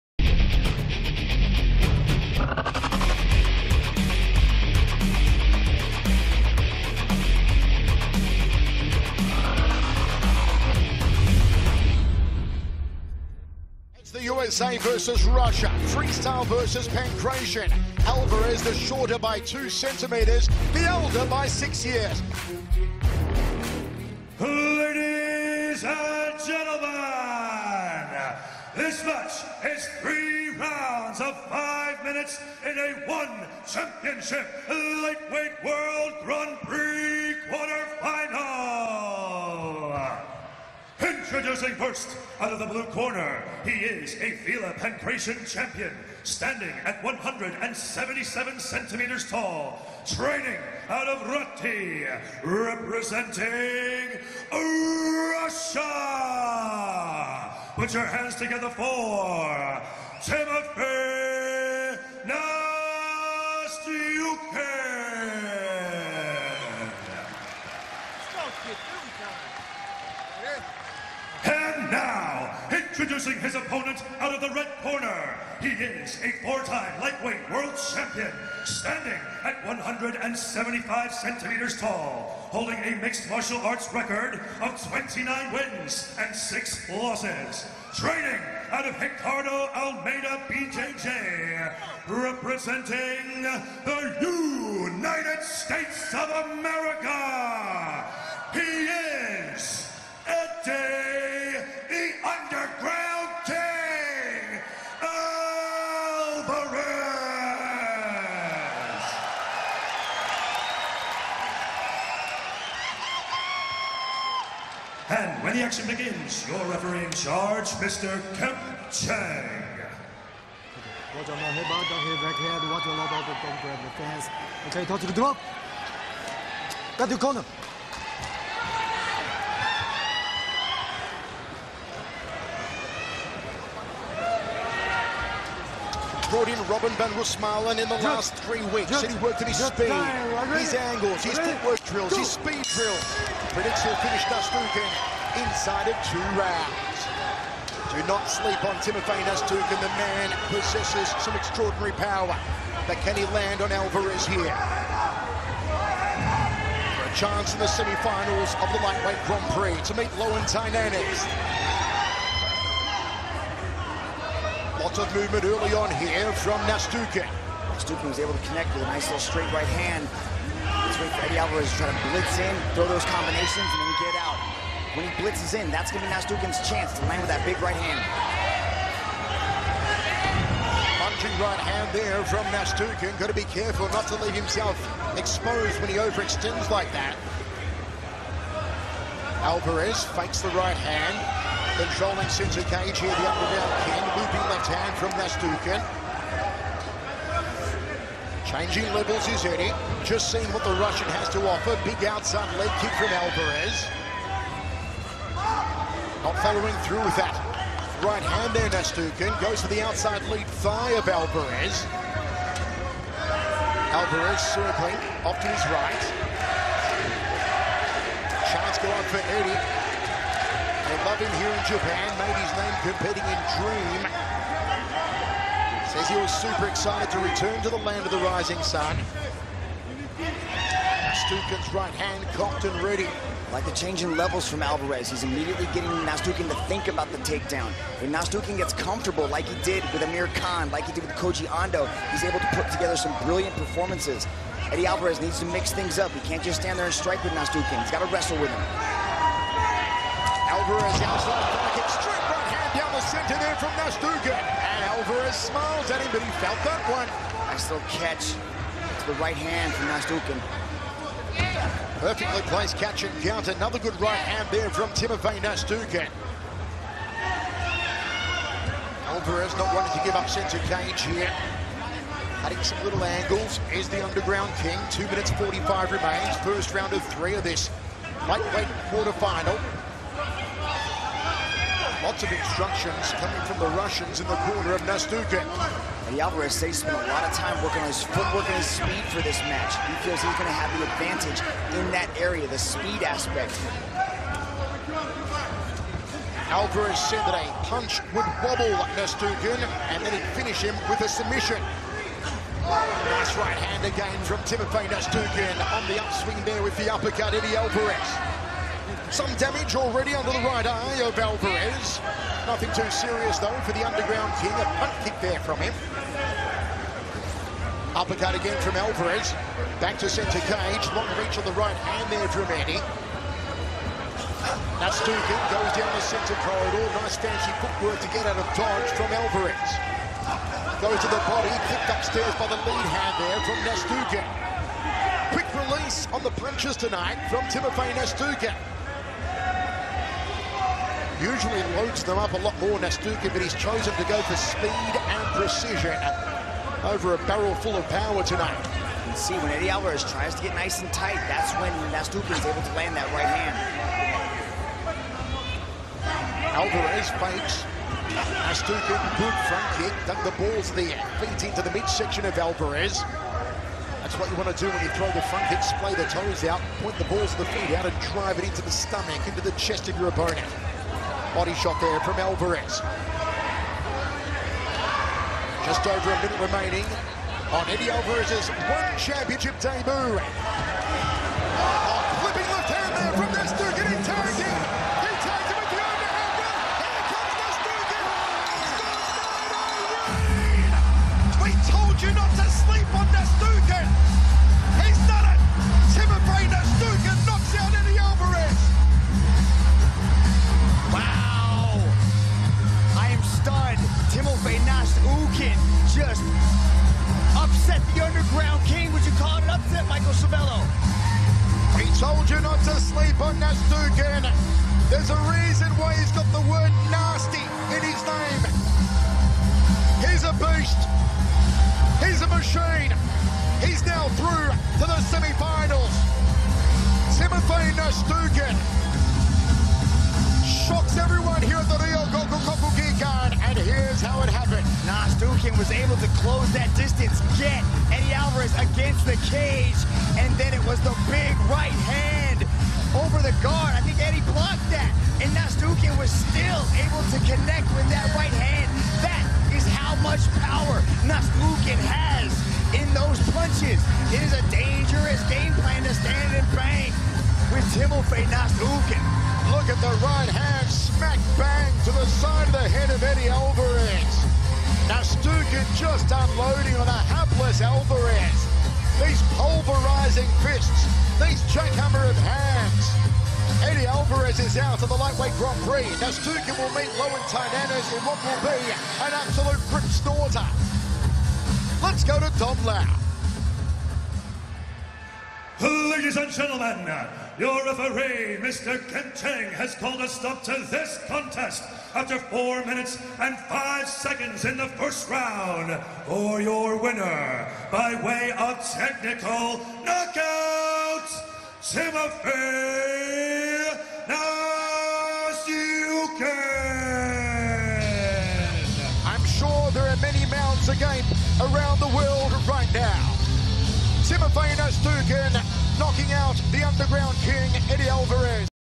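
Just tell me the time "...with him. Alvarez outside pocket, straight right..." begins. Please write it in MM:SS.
04:08.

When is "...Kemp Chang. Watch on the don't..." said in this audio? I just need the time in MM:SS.
01:58.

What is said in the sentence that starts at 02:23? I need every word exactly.
Predicts he'll finish Nastyukhin inside of two rounds.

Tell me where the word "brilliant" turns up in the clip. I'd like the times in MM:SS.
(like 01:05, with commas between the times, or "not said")
04:03.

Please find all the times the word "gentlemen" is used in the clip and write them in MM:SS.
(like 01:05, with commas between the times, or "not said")
00:26, 08:06.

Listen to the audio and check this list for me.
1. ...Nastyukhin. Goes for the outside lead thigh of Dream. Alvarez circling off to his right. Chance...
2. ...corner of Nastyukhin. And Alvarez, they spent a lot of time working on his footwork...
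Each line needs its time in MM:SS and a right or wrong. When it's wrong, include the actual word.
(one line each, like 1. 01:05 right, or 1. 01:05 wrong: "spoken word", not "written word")
1. 03:28 wrong: "Alvarez", not "Dream"
2. 04:44 right.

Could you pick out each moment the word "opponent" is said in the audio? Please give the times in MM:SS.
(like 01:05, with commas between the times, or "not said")
01:13, 06:10.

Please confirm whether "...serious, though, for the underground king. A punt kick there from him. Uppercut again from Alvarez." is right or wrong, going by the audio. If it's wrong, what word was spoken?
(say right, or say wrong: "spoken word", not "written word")
right.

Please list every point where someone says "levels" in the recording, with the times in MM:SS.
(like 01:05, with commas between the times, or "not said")
03:18, 03:54.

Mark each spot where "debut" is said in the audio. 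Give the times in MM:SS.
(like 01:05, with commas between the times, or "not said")
06:19.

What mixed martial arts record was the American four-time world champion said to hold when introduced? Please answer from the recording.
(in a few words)
29 wins and 6 losses.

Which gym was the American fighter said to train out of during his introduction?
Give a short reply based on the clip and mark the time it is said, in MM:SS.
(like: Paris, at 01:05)
Ricardo Almeida BJJ, at 01:29.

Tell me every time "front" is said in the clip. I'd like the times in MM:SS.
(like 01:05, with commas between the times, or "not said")
05:59, 06:05.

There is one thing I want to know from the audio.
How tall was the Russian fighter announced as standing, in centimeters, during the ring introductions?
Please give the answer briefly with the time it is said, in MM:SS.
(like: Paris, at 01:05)
177, at 00:47.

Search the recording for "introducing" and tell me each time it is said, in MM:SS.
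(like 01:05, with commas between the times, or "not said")
00:41, 01:13.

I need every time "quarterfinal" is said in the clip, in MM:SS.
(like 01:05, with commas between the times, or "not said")
00:37, 04:38.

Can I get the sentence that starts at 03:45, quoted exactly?
Says he was super excited to return to the land of the rising sun.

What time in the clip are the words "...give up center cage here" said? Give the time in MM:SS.
04:30.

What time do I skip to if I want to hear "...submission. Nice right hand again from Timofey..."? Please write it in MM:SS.
05:01.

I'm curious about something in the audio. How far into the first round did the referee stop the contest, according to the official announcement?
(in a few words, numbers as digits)
4 minutes 5 seconds.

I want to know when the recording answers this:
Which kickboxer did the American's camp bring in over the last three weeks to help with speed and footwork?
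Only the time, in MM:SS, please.
02:16.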